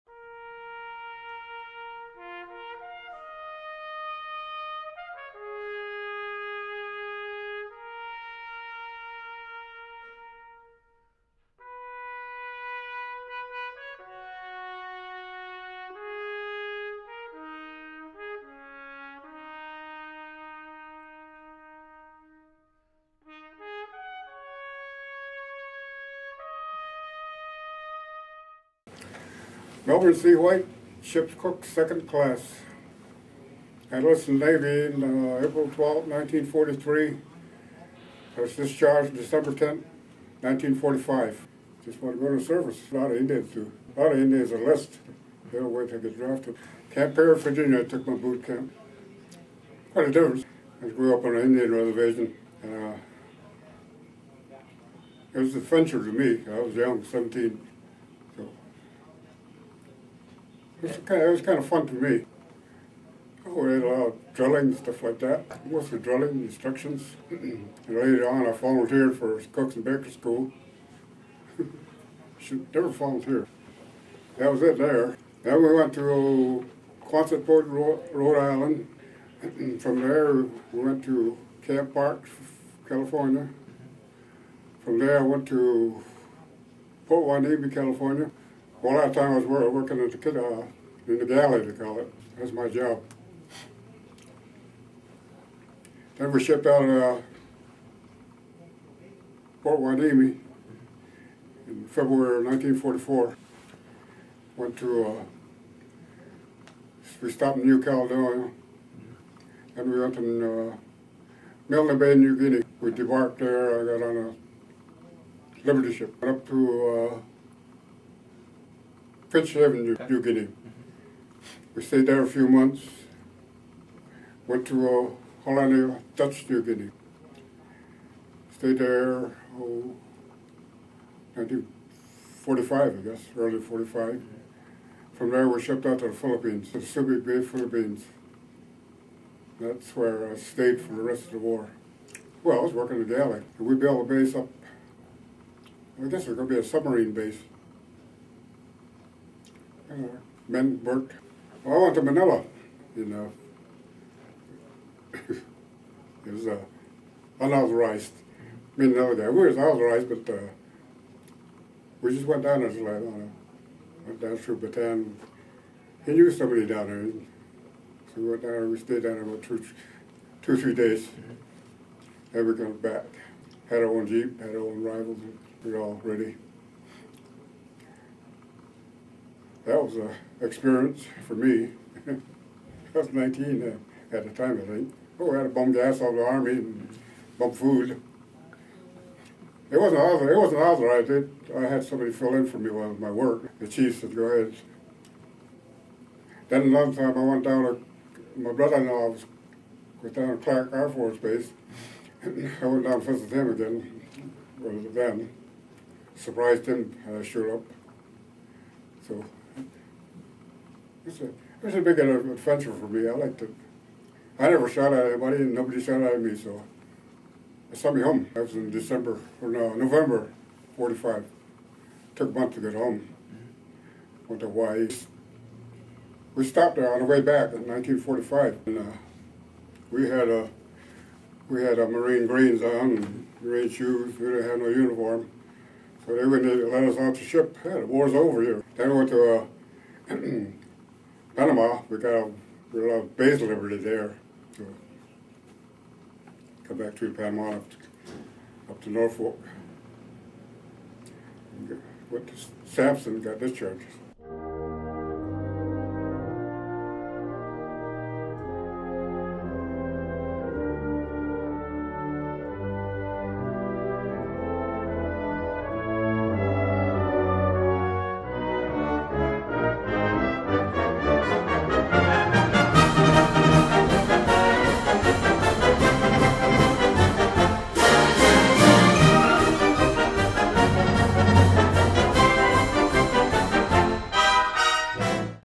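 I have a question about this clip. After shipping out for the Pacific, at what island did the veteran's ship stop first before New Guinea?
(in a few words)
New Caledonia.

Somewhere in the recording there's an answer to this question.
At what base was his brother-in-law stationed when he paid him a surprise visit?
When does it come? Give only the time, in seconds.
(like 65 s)
200 s.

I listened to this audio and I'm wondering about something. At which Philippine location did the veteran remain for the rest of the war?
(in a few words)
Subic Bay.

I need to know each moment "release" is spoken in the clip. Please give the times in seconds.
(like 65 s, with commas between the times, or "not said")
not said.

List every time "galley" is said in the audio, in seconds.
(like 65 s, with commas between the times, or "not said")
91 s, 143 s.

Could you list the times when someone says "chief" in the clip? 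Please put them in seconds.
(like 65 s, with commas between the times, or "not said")
193 s.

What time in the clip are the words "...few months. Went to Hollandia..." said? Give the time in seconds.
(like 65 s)
122 s.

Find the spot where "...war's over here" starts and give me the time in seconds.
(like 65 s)
237 s.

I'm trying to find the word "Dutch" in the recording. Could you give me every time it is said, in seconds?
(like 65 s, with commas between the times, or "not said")
126 s.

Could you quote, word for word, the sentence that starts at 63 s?
Oh, lot of drilling and stuff like that.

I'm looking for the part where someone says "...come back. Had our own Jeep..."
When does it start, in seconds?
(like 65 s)
172 s.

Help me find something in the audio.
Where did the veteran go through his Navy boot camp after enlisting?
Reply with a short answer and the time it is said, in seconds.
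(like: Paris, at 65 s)
Camp Peary, Virginia, at 46 s.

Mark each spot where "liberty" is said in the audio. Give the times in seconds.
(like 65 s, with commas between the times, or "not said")
115 s, 243 s.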